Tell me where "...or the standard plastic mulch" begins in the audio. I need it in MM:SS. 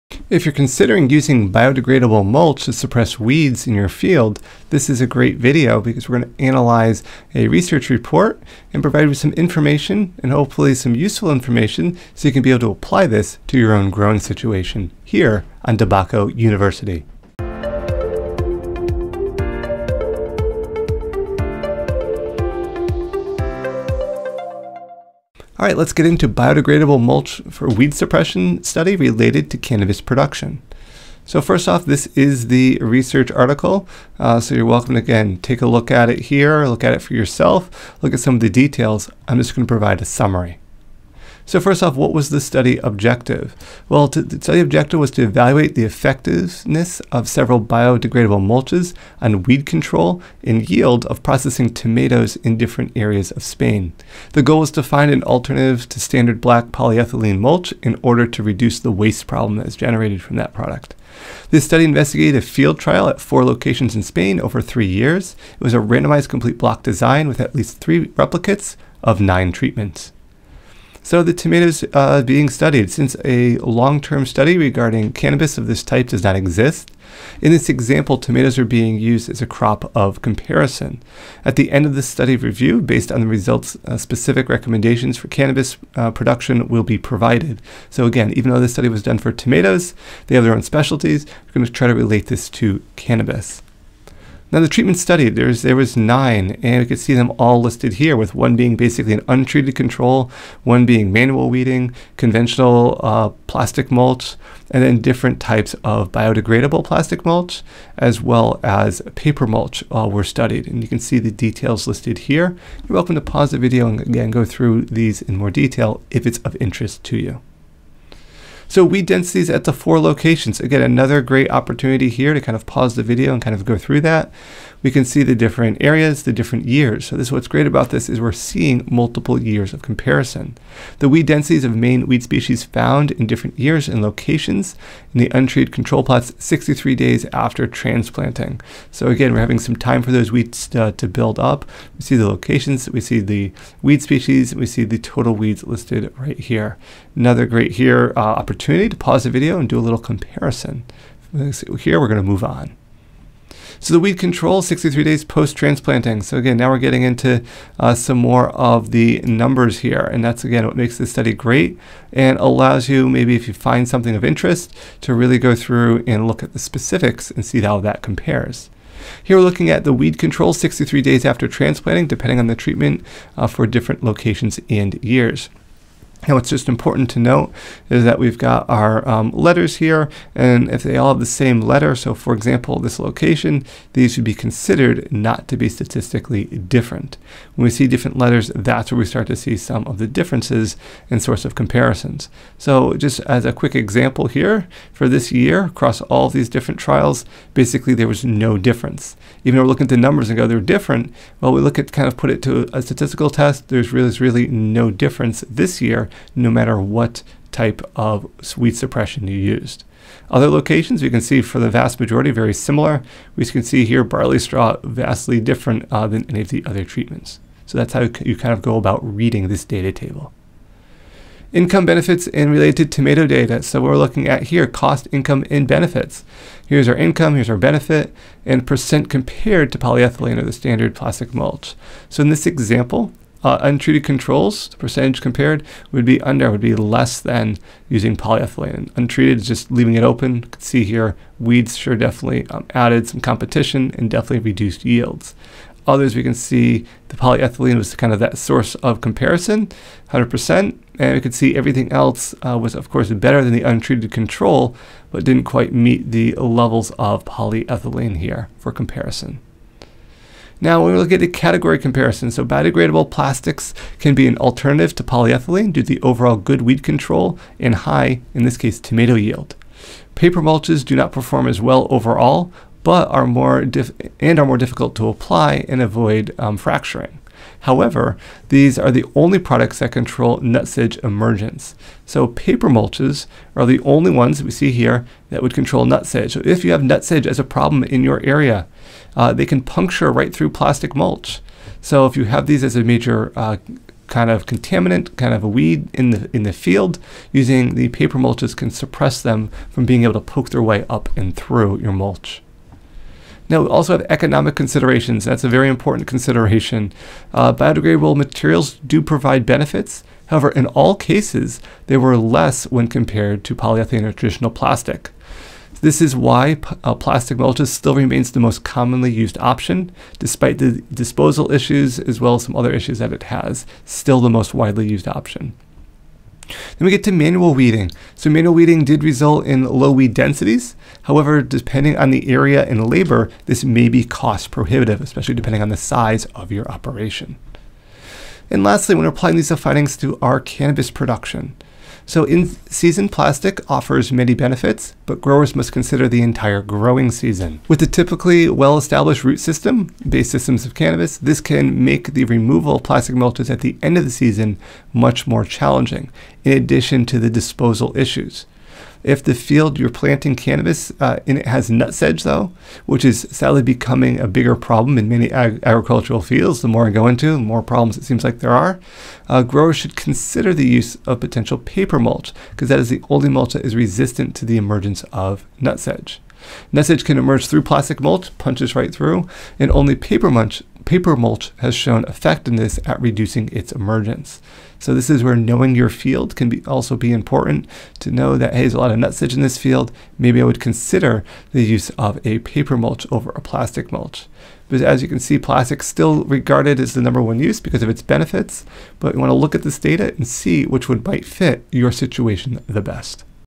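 03:50.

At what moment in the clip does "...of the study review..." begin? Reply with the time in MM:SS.
01:21.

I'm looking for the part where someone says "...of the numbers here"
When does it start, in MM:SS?
02:38.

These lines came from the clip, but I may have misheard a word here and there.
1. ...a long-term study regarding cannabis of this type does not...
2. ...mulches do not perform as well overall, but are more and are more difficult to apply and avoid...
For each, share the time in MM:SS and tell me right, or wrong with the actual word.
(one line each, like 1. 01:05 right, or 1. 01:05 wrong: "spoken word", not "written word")
1. 01:13 right
2. 04:30 right.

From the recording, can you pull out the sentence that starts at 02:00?
Again, another great opportunity here to kind of pause the video and kind of go through that.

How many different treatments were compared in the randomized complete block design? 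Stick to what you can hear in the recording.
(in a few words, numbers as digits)
9.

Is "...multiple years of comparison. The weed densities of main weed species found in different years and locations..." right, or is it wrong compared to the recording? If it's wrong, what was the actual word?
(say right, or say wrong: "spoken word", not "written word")
right.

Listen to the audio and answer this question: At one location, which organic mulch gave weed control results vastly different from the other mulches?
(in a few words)
barley straw.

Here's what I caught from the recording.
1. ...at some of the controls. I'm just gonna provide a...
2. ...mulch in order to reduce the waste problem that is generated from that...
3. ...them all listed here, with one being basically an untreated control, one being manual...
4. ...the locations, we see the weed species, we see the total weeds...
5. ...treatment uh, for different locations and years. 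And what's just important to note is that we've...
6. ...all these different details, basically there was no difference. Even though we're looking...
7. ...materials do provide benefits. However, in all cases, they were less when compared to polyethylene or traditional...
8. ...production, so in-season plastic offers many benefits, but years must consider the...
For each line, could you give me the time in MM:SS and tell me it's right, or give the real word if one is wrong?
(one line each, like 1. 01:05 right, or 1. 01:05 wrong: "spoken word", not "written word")
1. 00:38 wrong: "details", not "controls"
2. 00:57 right
3. 01:37 right
4. 02:22 right
5. 02:52 right
6. 03:16 wrong: "trials", not "details"
7. 05:08 right
8. 05:40 wrong: "growers", not "years".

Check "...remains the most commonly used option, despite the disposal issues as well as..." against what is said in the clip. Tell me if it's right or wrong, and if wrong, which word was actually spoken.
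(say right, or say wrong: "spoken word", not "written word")
right.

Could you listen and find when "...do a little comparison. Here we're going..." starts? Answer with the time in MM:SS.
02:29.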